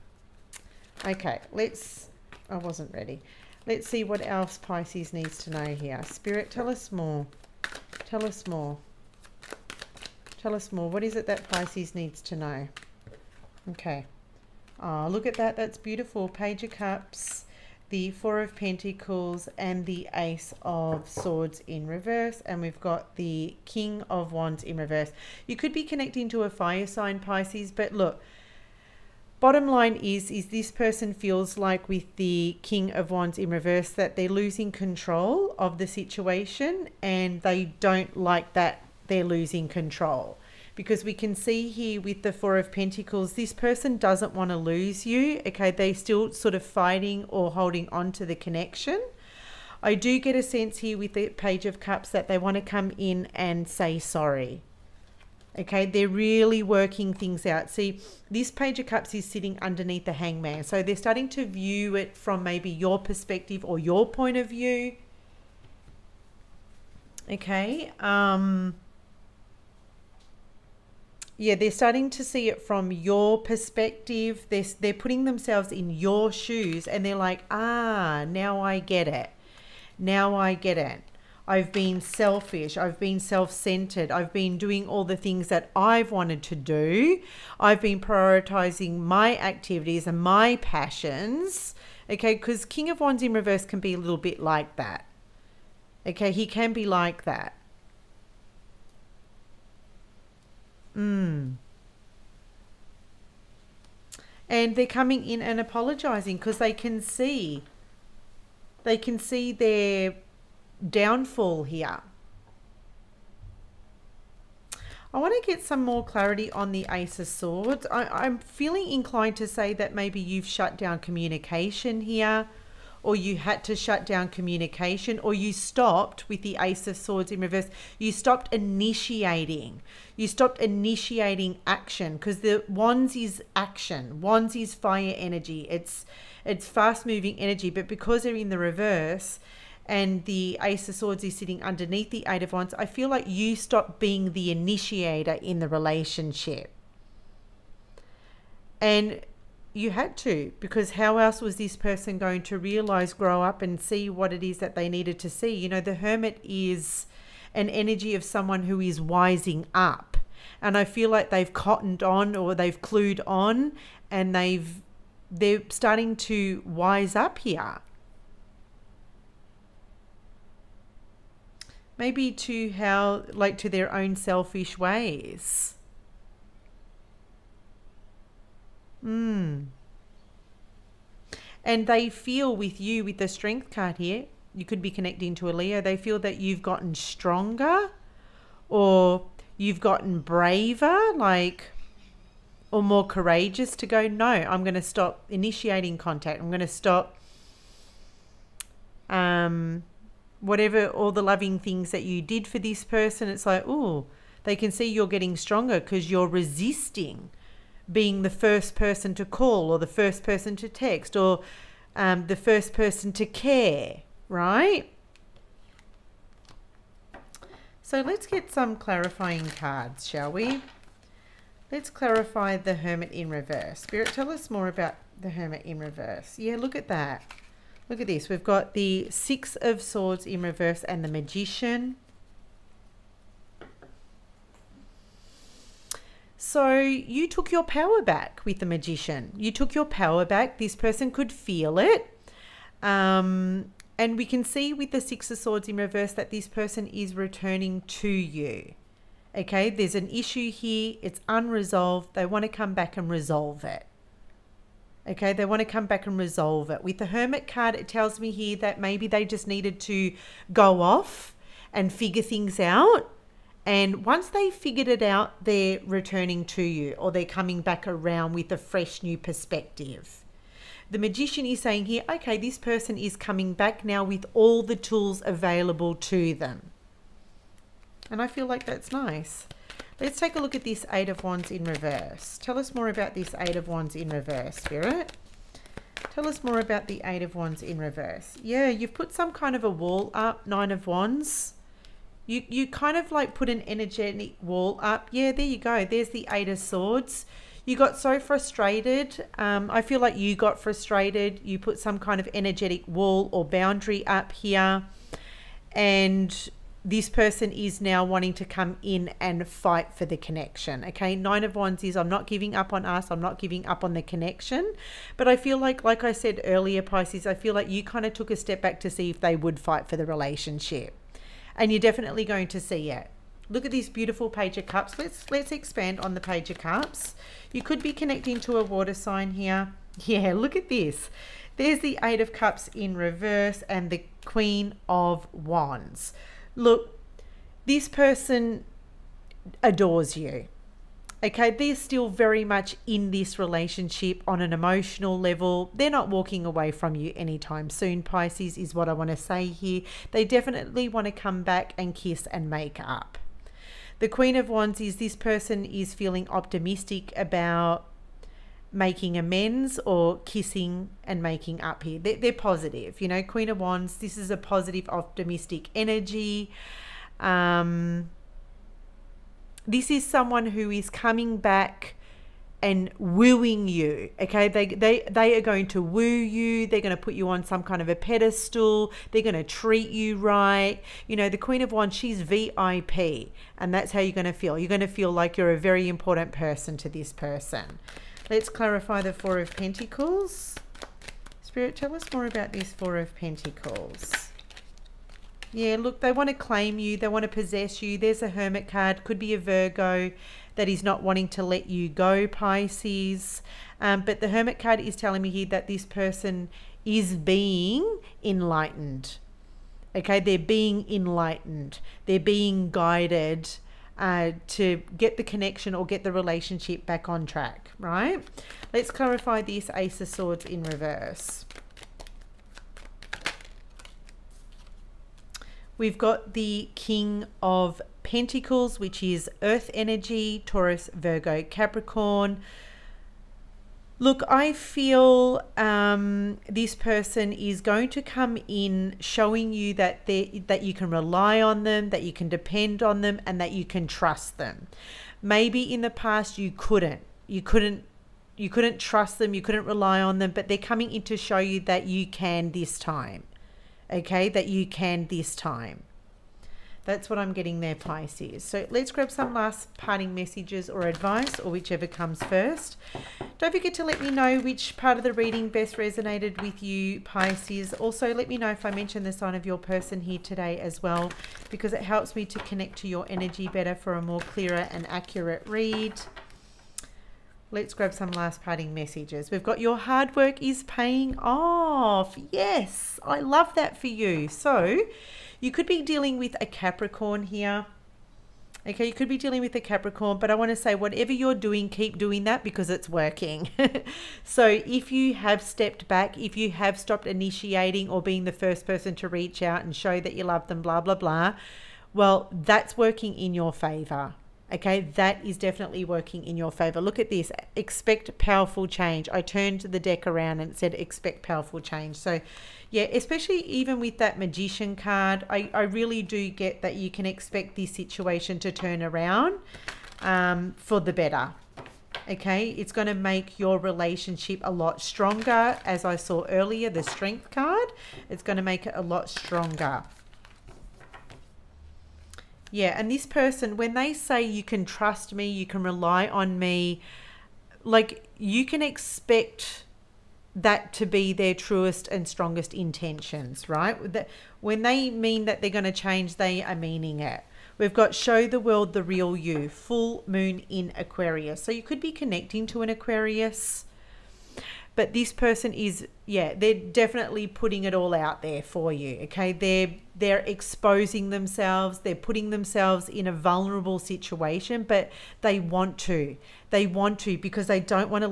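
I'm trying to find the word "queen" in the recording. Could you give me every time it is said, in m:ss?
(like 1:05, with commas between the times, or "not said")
5:34, 5:54, 6:03, 6:21.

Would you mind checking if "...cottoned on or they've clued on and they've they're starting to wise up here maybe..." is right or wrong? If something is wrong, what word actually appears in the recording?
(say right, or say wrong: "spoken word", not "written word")
right.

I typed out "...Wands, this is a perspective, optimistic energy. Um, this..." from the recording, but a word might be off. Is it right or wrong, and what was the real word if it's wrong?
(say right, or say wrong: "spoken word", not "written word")
wrong: "positive", not "perspective".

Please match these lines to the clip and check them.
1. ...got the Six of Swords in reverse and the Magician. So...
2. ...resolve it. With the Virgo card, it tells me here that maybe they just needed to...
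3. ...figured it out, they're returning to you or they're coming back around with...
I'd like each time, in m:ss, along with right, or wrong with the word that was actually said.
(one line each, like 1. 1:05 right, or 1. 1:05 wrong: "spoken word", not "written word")
1. 3:48 right
2. 4:16 wrong: "Hermit", not "Virgo"
3. 4:24 right.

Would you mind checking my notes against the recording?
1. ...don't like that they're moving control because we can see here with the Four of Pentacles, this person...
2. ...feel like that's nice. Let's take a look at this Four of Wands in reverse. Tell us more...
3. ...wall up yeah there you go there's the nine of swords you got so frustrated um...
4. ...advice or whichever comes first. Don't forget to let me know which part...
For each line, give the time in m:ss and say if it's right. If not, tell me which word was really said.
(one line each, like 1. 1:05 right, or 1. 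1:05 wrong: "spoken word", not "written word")
1. 0:37 wrong: "losing", not "moving"
2. 4:38 wrong: "Eight", not "Four"
3. 4:54 wrong: "eight", not "nine"
4. 7:40 right.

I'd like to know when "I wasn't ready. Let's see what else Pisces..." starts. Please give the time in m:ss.
0:02.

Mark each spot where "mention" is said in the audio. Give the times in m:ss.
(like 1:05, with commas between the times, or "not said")
7:48.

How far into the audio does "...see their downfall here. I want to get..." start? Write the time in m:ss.
1:49.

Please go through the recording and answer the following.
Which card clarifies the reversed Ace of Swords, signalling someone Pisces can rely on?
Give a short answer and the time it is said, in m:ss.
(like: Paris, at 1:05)
King of Pentacles, at 7:06.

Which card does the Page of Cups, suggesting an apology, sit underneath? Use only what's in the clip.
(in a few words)
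the hangman.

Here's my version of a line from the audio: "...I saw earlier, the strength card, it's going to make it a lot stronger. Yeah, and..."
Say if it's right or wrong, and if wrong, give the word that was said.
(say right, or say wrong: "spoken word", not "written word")
right.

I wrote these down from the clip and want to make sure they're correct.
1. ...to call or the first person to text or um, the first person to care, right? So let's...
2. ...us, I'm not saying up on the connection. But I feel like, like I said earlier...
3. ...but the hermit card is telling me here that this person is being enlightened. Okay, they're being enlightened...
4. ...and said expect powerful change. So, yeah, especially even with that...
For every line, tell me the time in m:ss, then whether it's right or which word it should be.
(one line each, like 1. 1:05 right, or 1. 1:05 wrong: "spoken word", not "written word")
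1. 3:29 right
2. 5:12 wrong: "giving", not "saying"
3. 6:44 right
4. 8:30 right.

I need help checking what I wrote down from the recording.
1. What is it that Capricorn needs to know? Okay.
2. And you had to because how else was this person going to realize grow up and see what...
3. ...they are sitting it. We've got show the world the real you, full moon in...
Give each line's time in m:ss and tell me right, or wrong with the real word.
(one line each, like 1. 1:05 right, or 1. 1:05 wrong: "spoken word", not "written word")
1. 0:10 wrong: "Pisces", not "Capricorn"
2. 2:28 right
3. 9:06 wrong: "meaning", not "sitting".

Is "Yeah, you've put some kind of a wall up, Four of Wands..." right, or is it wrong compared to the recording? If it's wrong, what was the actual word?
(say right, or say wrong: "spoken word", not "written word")
wrong: "Nine", not "Four".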